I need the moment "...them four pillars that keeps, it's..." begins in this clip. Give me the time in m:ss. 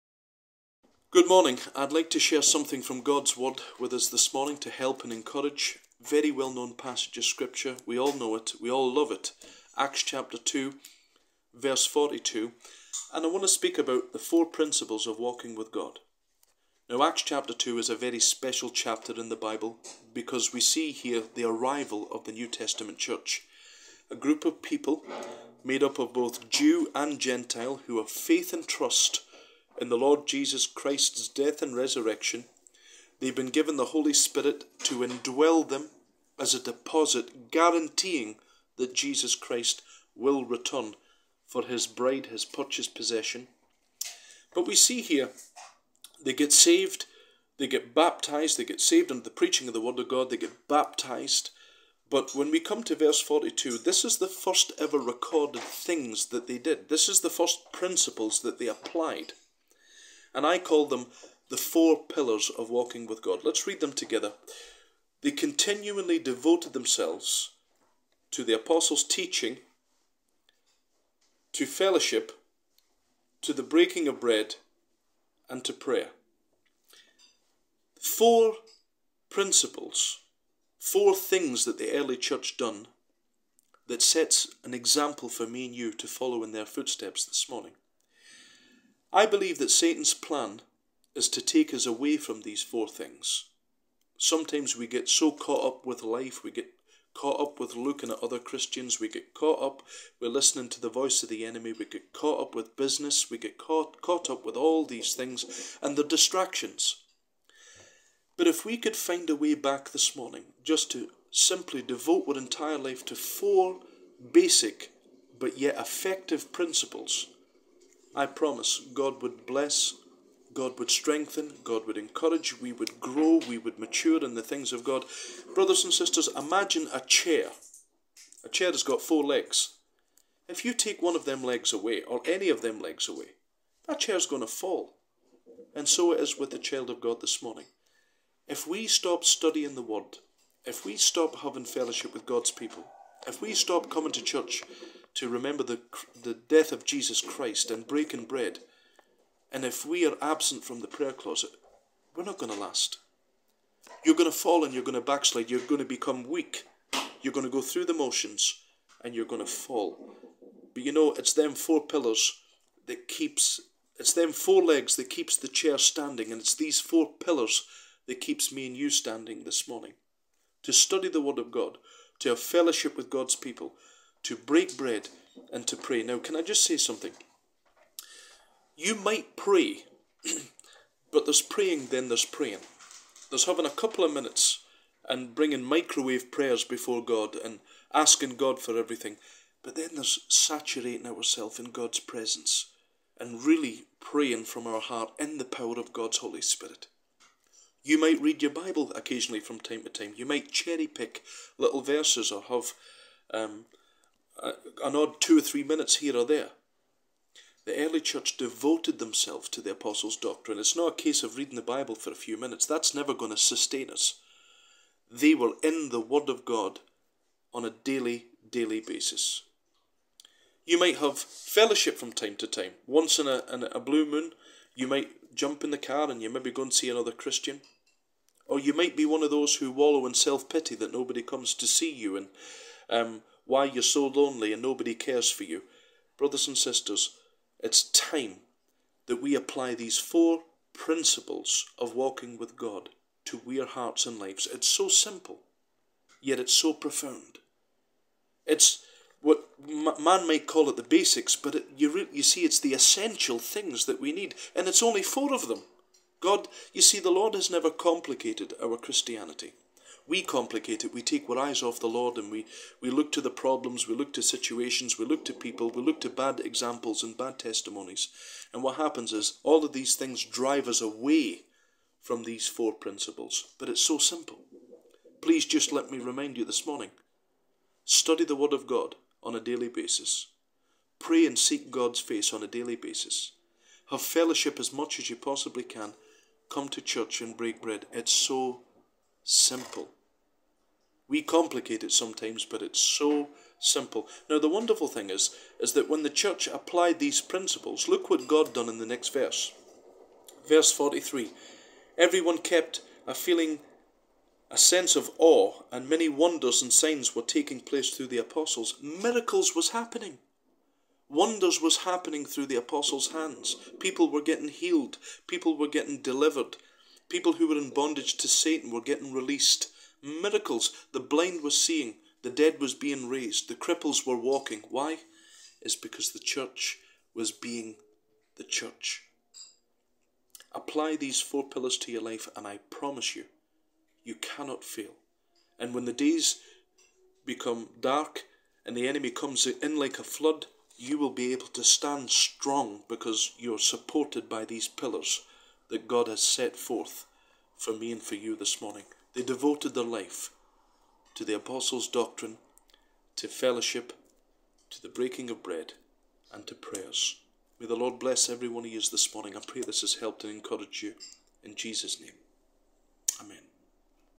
2:41.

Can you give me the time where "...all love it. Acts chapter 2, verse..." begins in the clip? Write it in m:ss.
0:08.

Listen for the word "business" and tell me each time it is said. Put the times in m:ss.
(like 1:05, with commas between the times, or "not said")
1:42.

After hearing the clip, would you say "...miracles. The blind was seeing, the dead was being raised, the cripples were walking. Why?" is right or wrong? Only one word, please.
right.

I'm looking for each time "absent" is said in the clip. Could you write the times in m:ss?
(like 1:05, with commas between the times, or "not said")
2:30.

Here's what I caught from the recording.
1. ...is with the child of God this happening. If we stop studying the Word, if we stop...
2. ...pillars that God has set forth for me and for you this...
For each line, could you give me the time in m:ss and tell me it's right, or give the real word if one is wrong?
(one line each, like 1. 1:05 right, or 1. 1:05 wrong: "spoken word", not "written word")
1. 2:16 wrong: "morning", not "happening"
2. 5:44 right.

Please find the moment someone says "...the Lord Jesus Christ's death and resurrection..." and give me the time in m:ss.
0:29.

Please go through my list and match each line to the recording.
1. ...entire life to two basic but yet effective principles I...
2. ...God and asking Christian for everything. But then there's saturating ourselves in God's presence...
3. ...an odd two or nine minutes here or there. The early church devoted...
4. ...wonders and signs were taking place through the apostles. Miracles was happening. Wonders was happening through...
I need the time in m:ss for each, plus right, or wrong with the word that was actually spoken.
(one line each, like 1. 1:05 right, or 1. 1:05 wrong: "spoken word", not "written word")
1. 1:52 wrong: "four", not "two"
2. 3:07 wrong: "God", not "Christian"
3. 3:24 wrong: "three", not "nine"
4. 5:06 right.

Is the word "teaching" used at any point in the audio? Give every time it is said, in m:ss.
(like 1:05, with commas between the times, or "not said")
1:09.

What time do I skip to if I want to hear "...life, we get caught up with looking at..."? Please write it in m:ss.
1:36.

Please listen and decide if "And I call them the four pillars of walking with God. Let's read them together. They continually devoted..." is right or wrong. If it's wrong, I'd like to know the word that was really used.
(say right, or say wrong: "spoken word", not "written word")
right.